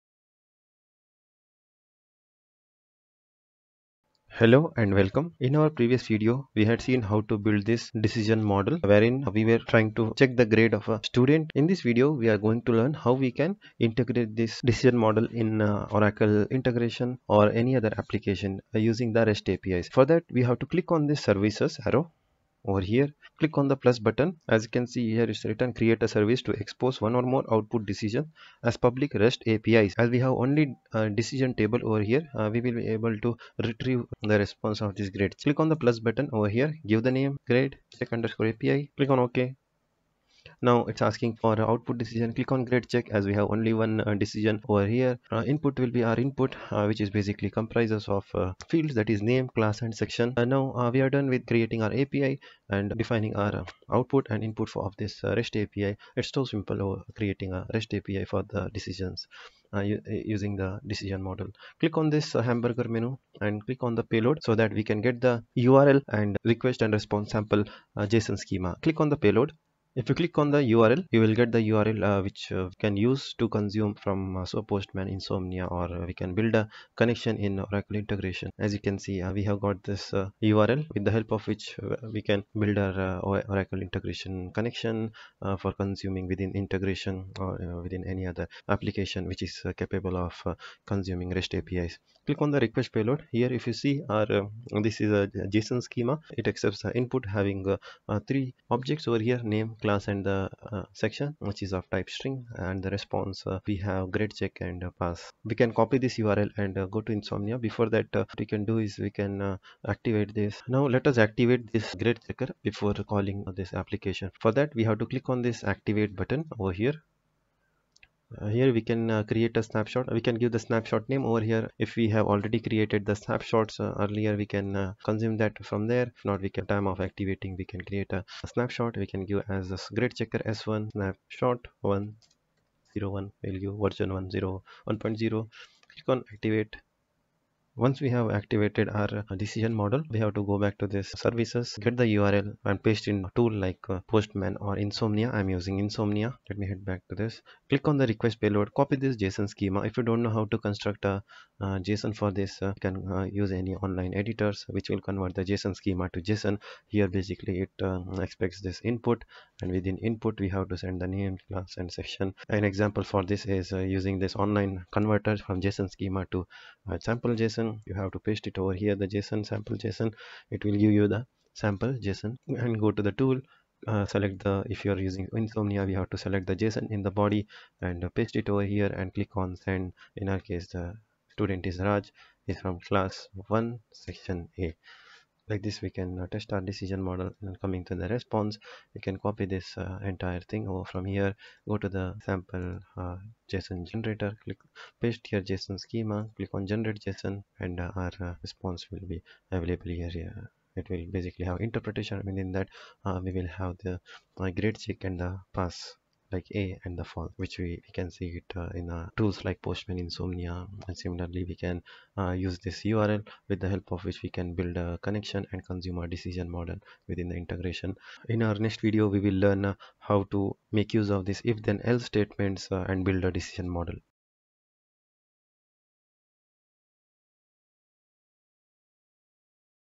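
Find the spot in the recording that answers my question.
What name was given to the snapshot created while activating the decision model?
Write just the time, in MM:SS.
02:09.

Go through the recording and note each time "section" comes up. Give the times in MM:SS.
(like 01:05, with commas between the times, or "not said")
00:49, 01:41, 02:41, 03:03.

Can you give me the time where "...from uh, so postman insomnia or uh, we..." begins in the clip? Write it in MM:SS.
01:13.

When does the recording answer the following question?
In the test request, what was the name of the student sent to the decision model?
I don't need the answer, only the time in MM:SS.
03:01.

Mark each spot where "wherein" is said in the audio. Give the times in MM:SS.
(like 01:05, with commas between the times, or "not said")
00:08.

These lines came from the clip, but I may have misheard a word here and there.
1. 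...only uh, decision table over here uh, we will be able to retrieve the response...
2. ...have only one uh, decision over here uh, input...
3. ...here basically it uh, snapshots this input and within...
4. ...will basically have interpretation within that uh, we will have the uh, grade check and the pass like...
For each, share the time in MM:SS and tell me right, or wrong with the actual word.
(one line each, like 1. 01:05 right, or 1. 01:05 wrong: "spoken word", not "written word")
1. 00:30 right
2. 00:43 right
3. 02:36 wrong: "expects", not "snapshots"
4. 03:20 right.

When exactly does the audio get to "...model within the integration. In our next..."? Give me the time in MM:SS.
03:36.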